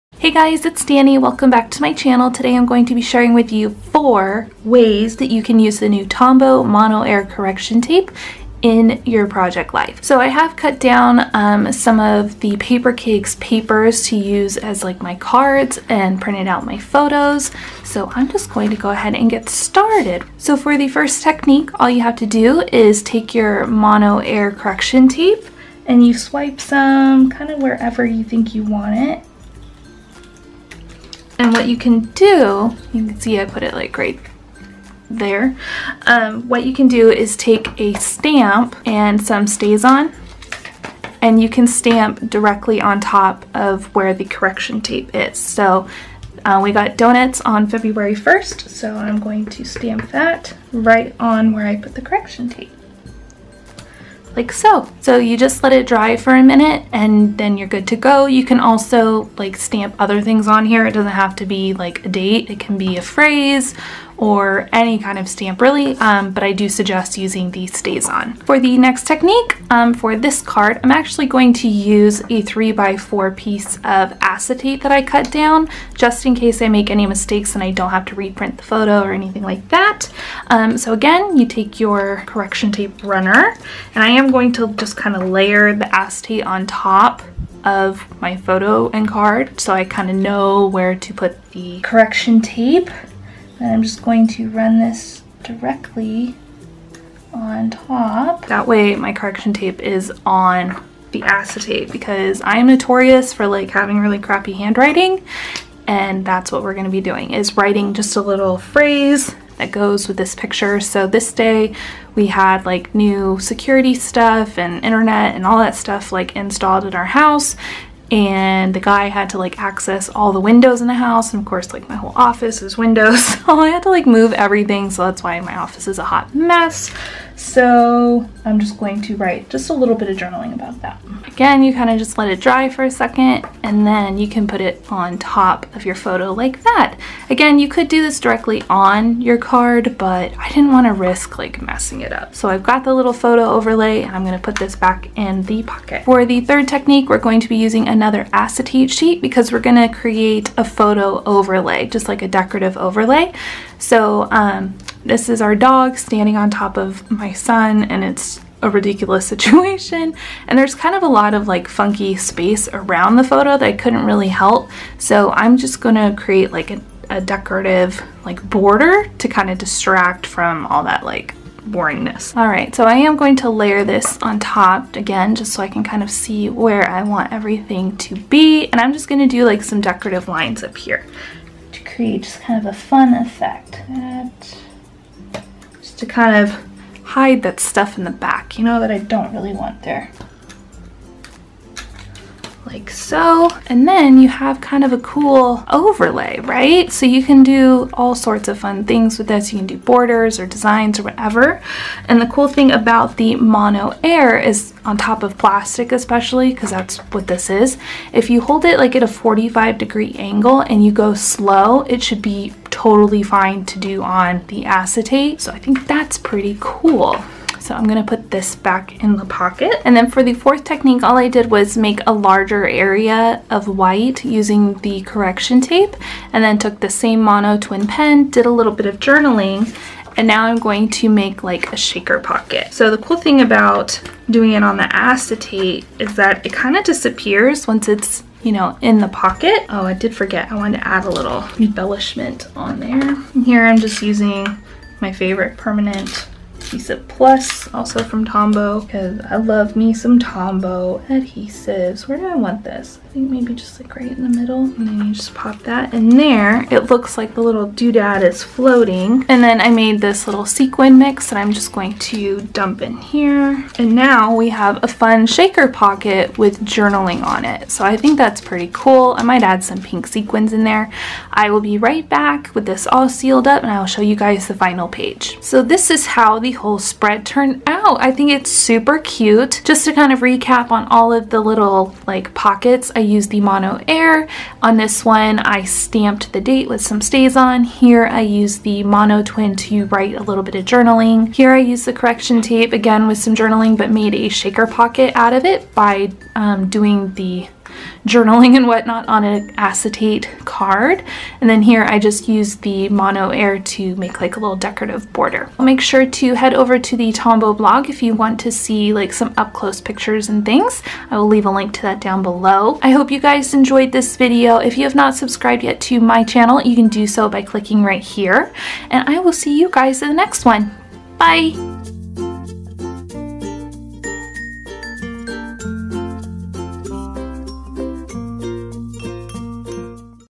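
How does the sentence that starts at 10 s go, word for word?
So I have cut down um, some of the Papercakes papers to use as like my cards and printed out my photos.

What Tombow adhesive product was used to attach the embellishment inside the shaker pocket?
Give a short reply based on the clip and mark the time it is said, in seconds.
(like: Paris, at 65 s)
Permanent adhesive plus, at 245 s.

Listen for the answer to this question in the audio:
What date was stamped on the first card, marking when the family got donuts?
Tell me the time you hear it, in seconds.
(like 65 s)
47 s.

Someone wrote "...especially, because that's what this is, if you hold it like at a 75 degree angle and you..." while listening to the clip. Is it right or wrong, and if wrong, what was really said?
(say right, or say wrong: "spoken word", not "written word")
wrong: "45", not "75".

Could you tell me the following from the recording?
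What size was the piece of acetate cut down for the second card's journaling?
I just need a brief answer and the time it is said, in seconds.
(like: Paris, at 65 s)
3 by 4, at 72 s.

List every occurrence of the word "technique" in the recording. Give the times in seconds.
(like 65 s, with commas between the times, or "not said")
21 s, 69 s, 146 s, 220 s.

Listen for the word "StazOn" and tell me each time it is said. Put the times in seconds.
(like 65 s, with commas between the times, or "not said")
39 s, 67 s, 286 s.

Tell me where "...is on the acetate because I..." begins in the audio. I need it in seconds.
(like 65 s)
99 s.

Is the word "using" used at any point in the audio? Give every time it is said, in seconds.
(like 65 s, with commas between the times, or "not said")
67 s, 147 s, 224 s, 244 s.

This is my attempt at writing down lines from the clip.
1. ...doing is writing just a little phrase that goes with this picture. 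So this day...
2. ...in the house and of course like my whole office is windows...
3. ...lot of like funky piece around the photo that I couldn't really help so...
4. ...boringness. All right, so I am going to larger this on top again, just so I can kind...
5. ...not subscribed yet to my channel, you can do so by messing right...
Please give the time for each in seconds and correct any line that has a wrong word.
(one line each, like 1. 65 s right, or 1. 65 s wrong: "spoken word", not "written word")
1. 107 s right
2. 120 s right
3. 161 s wrong: "space", not "piece"
4. 171 s wrong: "layer", not "larger"
5. 314 s wrong: "clicking", not "messing".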